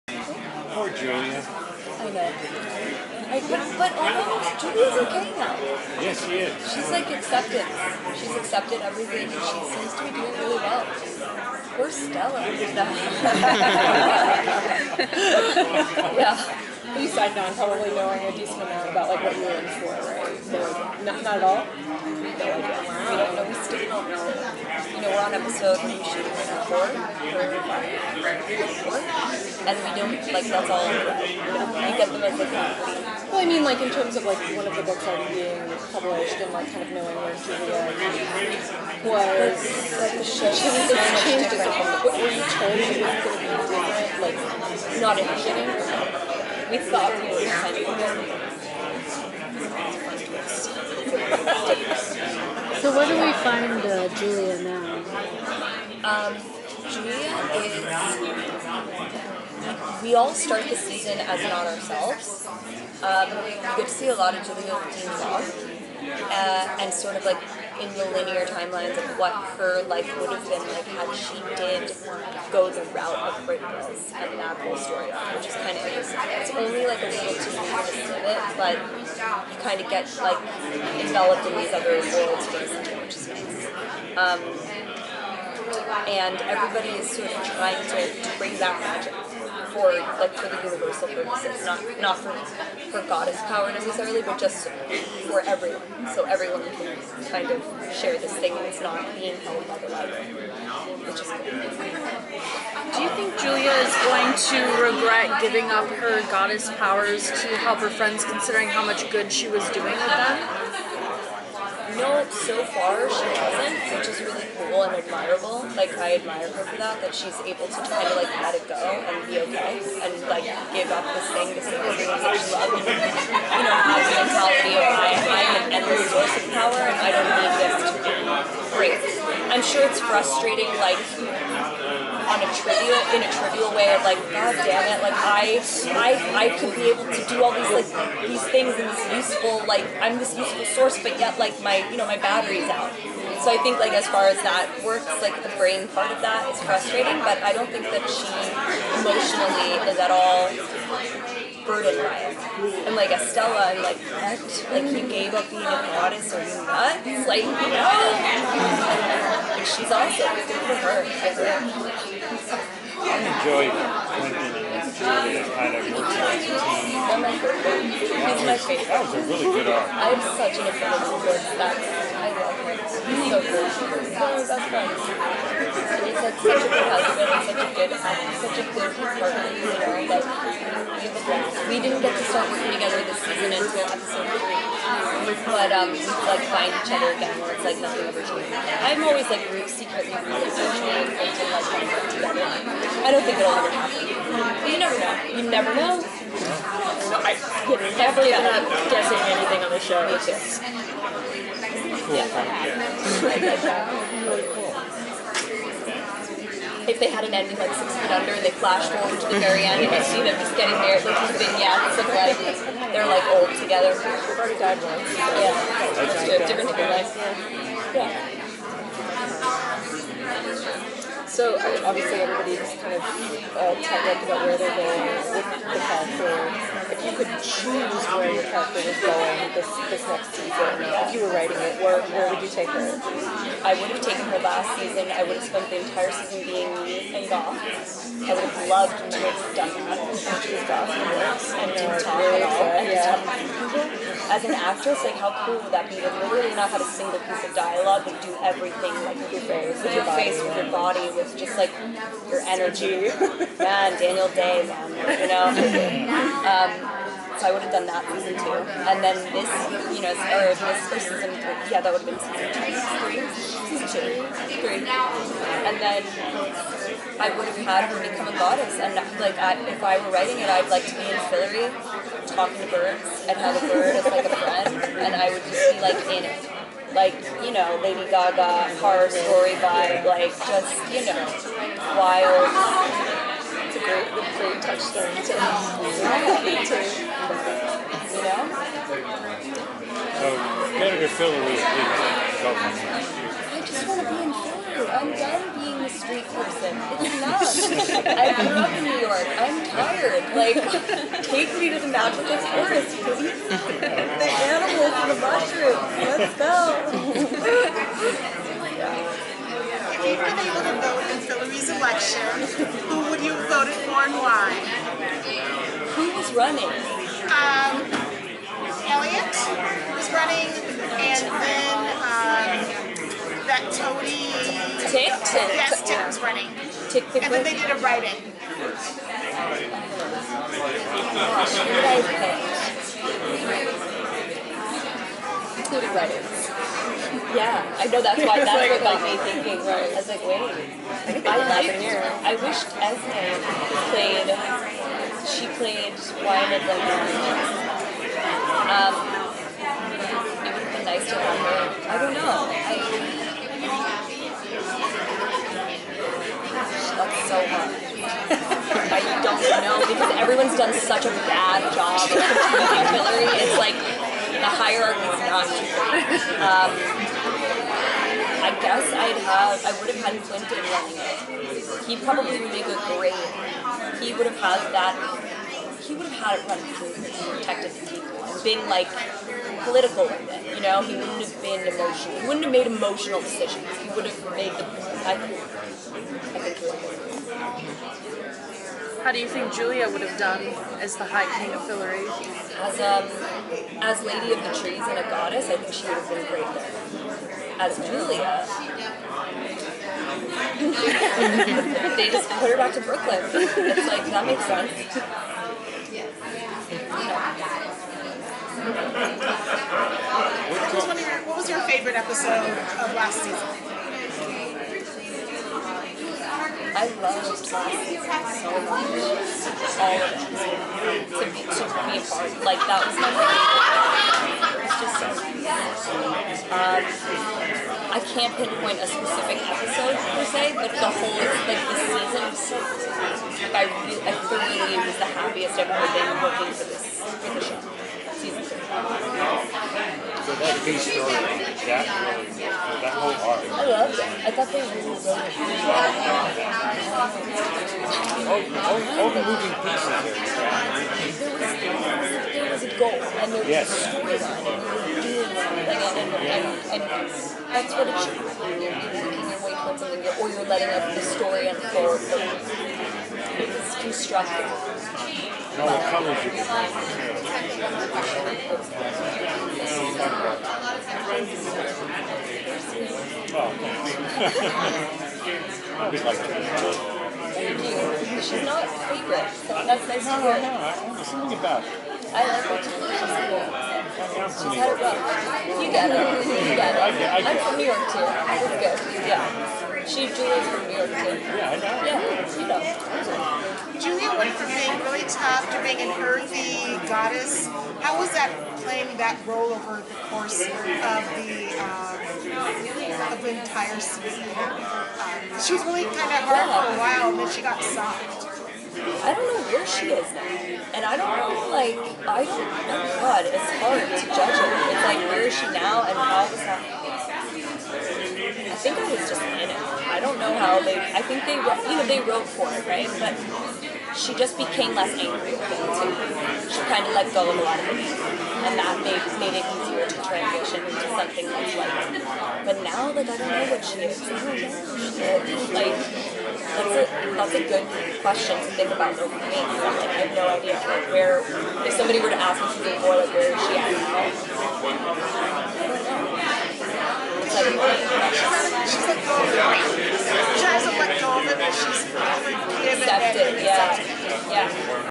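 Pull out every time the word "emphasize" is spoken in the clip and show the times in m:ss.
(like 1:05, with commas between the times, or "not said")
not said.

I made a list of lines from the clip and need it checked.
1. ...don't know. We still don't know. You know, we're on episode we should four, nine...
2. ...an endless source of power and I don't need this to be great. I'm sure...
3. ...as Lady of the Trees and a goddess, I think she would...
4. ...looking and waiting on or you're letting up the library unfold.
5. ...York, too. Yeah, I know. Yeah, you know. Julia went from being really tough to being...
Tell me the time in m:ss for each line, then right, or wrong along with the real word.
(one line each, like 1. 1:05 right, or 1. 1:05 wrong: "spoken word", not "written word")
1. 0:22 wrong: "four", not "nine"
2. 2:05 right
3. 6:33 right
4. 7:38 wrong: "story", not "library"
5. 8:10 right.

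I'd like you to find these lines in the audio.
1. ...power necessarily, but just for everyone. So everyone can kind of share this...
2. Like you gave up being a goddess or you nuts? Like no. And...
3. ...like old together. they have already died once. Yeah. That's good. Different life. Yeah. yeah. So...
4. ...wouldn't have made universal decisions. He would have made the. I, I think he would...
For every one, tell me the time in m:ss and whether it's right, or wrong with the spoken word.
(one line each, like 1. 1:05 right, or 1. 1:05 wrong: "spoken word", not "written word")
1. 1:33 right
2. 2:34 right
3. 3:33 right
4. 6:22 wrong: "emotional", not "universal".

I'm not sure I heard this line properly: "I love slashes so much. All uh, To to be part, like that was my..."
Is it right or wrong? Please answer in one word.
right.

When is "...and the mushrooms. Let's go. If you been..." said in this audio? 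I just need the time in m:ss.
5:05.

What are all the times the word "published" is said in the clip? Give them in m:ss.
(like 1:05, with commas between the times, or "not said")
0:35.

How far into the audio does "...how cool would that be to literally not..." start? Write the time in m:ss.
4:05.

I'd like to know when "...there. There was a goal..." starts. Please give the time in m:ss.
7:31.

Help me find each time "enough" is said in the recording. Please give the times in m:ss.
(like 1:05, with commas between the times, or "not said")
4:57.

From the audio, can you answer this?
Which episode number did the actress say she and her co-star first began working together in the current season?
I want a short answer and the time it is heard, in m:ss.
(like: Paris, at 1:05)
3, at 3:03.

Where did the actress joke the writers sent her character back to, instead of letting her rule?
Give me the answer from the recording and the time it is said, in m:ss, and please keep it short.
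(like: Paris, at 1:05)
Brooklyn, at 6:42.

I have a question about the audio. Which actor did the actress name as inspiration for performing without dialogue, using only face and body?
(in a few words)
Daniel Day.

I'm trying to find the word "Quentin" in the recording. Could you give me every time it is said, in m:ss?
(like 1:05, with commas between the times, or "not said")
2:43, 6:10.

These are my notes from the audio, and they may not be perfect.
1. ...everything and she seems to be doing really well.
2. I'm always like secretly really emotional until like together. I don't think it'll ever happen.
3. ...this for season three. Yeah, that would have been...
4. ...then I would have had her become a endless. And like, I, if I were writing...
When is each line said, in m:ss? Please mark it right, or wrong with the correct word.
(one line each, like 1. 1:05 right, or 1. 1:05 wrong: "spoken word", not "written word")
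1. 0:08 right
2. 3:08 right
3. 4:20 right
4. 4:25 wrong: "goddess", not "endless".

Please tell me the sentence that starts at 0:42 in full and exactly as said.
Were you told it was going to be different, like not initiating?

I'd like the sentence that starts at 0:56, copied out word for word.
Um, Julia is we all start the season as not ourselves.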